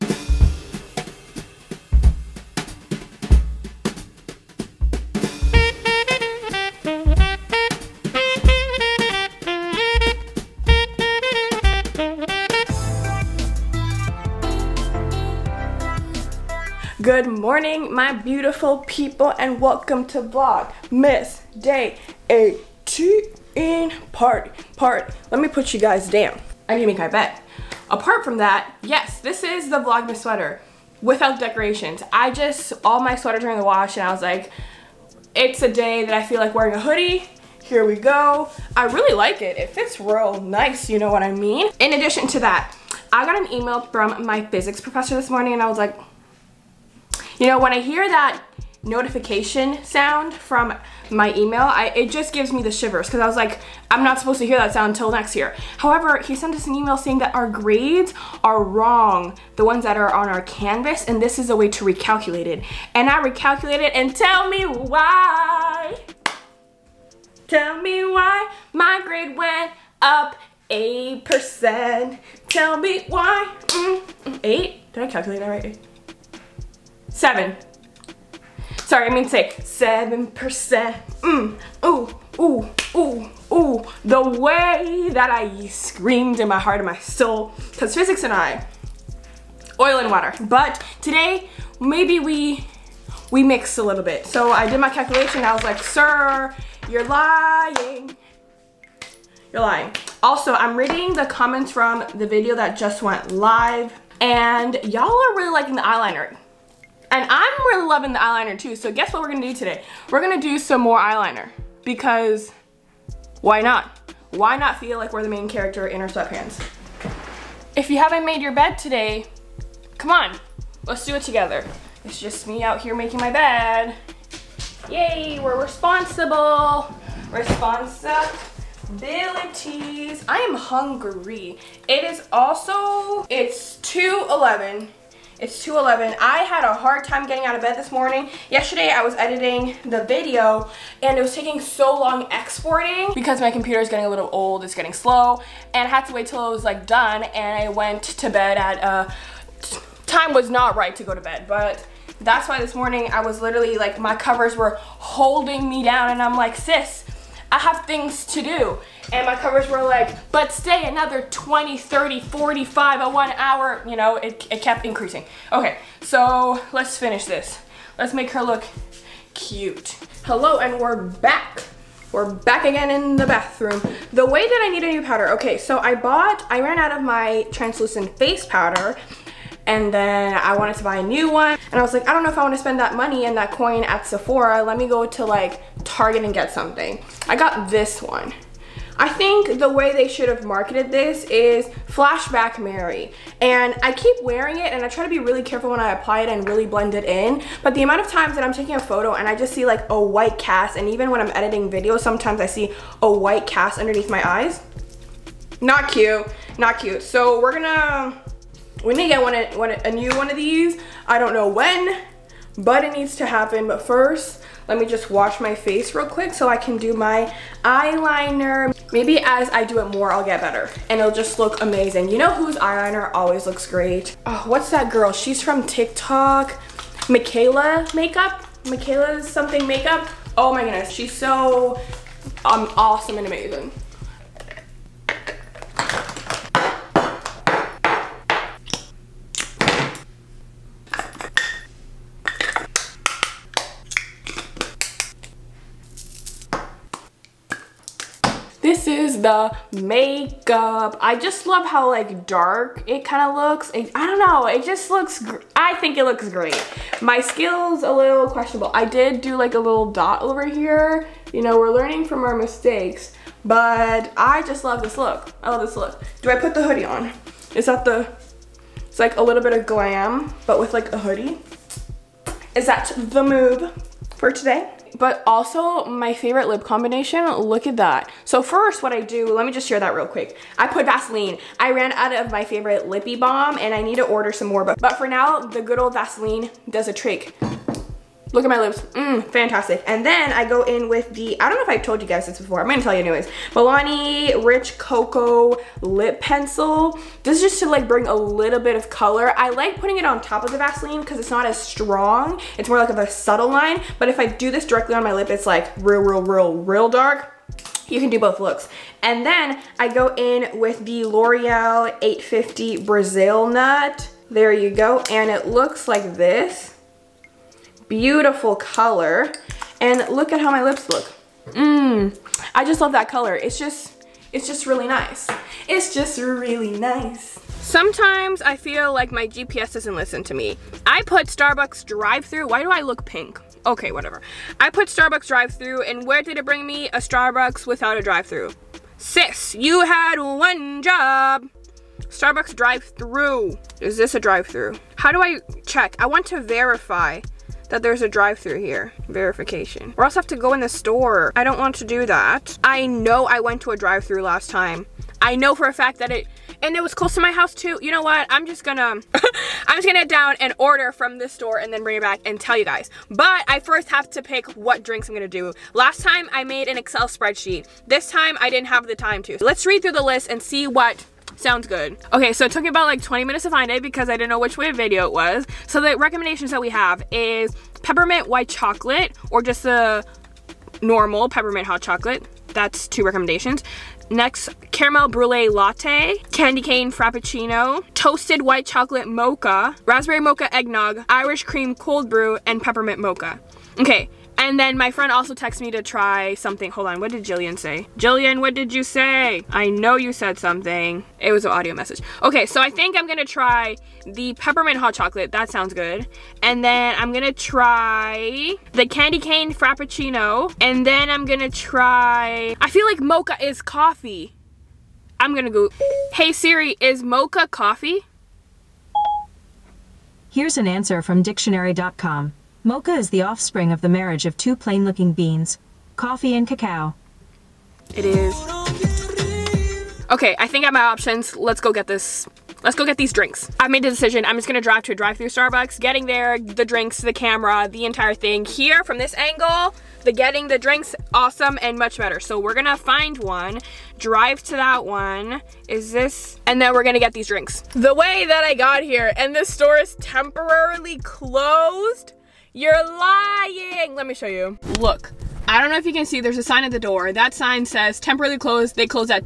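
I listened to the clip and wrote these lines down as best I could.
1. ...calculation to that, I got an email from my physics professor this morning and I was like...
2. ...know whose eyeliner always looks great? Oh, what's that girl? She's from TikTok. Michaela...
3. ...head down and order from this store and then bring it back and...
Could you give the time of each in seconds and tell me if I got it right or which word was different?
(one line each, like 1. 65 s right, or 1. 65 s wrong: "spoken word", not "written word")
1. 41 s wrong: "addition", not "calculation"
2. 222 s right
3. 359 s right.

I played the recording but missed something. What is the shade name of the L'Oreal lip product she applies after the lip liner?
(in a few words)
850 Brazil Nut.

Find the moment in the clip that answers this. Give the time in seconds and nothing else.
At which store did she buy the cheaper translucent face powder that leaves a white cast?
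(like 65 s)
185 s.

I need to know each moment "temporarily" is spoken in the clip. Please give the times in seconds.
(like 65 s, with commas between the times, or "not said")
449 s, 457 s.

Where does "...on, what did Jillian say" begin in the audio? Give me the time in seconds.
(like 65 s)
396 s.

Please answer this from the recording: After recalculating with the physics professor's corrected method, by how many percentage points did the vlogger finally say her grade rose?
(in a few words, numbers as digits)
7.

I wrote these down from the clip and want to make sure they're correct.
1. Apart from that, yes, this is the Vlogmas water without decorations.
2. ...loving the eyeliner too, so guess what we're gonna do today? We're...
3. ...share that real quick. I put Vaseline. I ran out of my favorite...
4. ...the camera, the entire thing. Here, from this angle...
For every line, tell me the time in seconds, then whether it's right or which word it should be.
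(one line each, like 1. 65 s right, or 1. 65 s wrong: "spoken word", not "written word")
1. 27 s wrong: "sweater", not "water"
2. 107 s right
3. 279 s right
4. 437 s right.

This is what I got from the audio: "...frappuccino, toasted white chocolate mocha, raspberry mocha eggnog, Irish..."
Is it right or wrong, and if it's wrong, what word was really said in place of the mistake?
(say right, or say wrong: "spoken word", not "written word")
right.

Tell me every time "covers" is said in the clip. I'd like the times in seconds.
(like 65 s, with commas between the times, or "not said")
154 s, 159 s.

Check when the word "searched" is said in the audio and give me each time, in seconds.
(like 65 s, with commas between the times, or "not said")
not said.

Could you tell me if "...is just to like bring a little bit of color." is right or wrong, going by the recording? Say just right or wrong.
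right.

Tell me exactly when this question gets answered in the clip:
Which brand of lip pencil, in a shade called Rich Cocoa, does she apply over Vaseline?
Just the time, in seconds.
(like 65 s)
293 s.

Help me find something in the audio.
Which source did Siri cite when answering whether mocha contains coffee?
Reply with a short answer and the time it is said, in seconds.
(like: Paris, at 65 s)
dictionary.com, at 421 s.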